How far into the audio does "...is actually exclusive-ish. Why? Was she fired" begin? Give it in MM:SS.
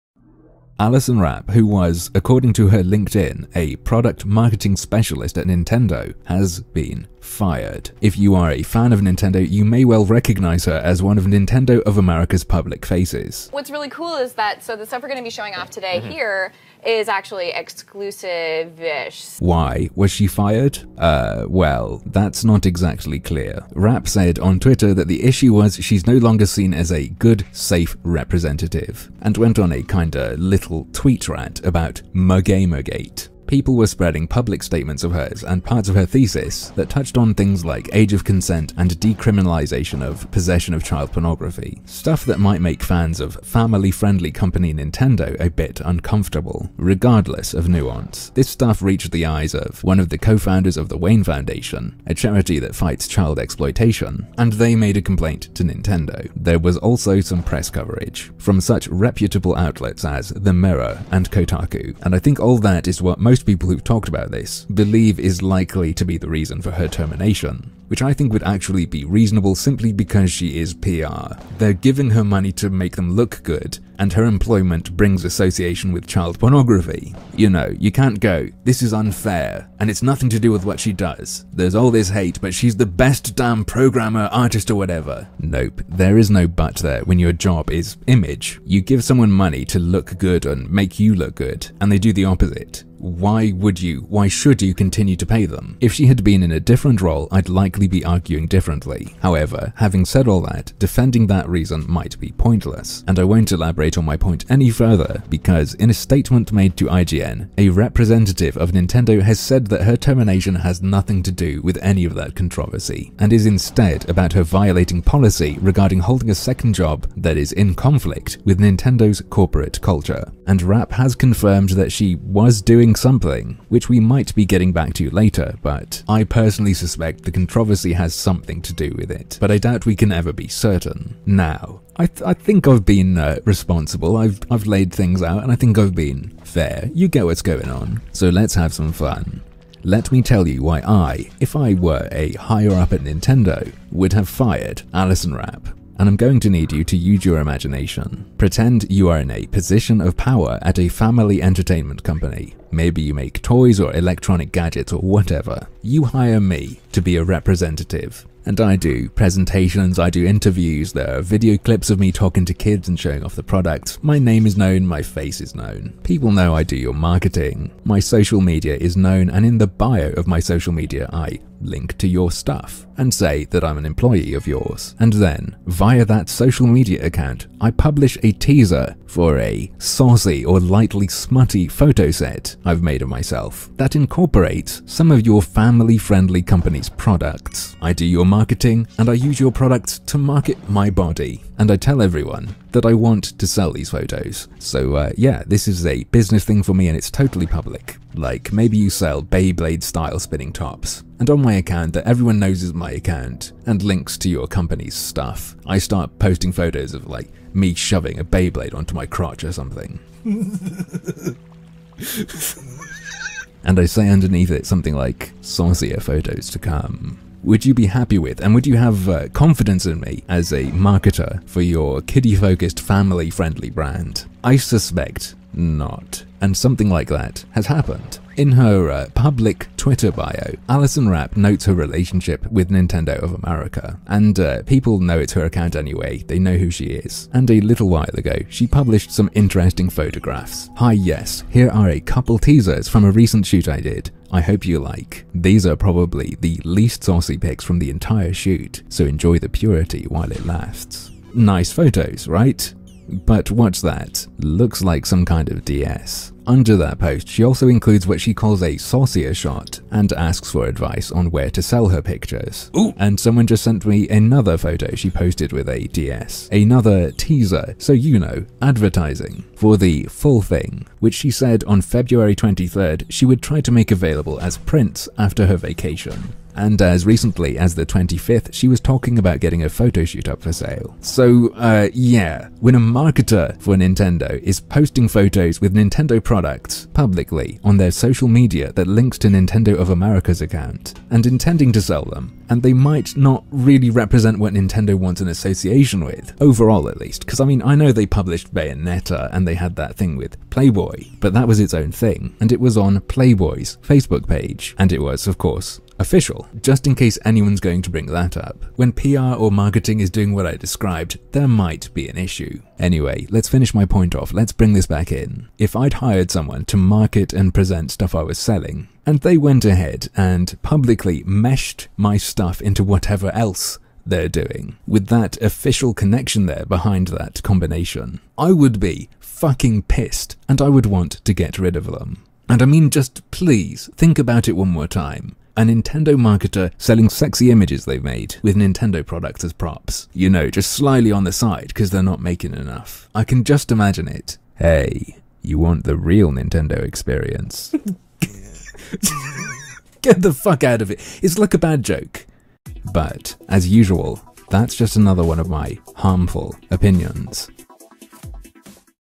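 00:16.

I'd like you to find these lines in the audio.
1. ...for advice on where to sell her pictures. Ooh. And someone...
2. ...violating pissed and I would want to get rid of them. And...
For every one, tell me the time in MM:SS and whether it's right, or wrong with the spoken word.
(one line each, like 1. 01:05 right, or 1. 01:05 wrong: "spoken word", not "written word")
1. 04:20 right
2. 05:29 wrong: "fucking", not "violating".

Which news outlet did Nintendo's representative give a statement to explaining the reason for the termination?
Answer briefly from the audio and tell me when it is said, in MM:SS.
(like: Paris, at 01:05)
IGN, at 01:46.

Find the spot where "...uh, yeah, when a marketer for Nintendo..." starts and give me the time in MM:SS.
04:41.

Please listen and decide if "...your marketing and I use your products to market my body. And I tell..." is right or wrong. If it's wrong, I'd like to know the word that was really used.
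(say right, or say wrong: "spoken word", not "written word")
right.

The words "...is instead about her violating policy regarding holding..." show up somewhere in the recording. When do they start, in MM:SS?
01:53.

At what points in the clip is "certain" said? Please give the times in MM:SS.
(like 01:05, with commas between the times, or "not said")
02:10.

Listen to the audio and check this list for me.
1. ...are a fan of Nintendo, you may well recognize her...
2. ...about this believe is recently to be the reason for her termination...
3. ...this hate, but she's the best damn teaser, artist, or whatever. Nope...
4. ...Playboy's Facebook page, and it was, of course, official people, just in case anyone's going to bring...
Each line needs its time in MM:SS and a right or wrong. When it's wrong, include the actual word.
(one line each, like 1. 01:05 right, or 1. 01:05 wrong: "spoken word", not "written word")
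1. 00:08 right
2. 01:04 wrong: "likely", not "recently"
3. 01:21 wrong: "programmer", not "teaser"
4. 05:03 right.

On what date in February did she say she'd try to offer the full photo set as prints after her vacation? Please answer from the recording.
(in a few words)
February 23.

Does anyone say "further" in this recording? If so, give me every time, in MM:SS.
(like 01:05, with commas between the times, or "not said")
01:44.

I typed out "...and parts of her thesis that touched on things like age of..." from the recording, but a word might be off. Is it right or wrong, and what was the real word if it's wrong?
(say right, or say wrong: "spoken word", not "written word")
right.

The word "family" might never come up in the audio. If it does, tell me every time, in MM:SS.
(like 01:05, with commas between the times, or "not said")
00:43, 02:30, 03:05, 03:42.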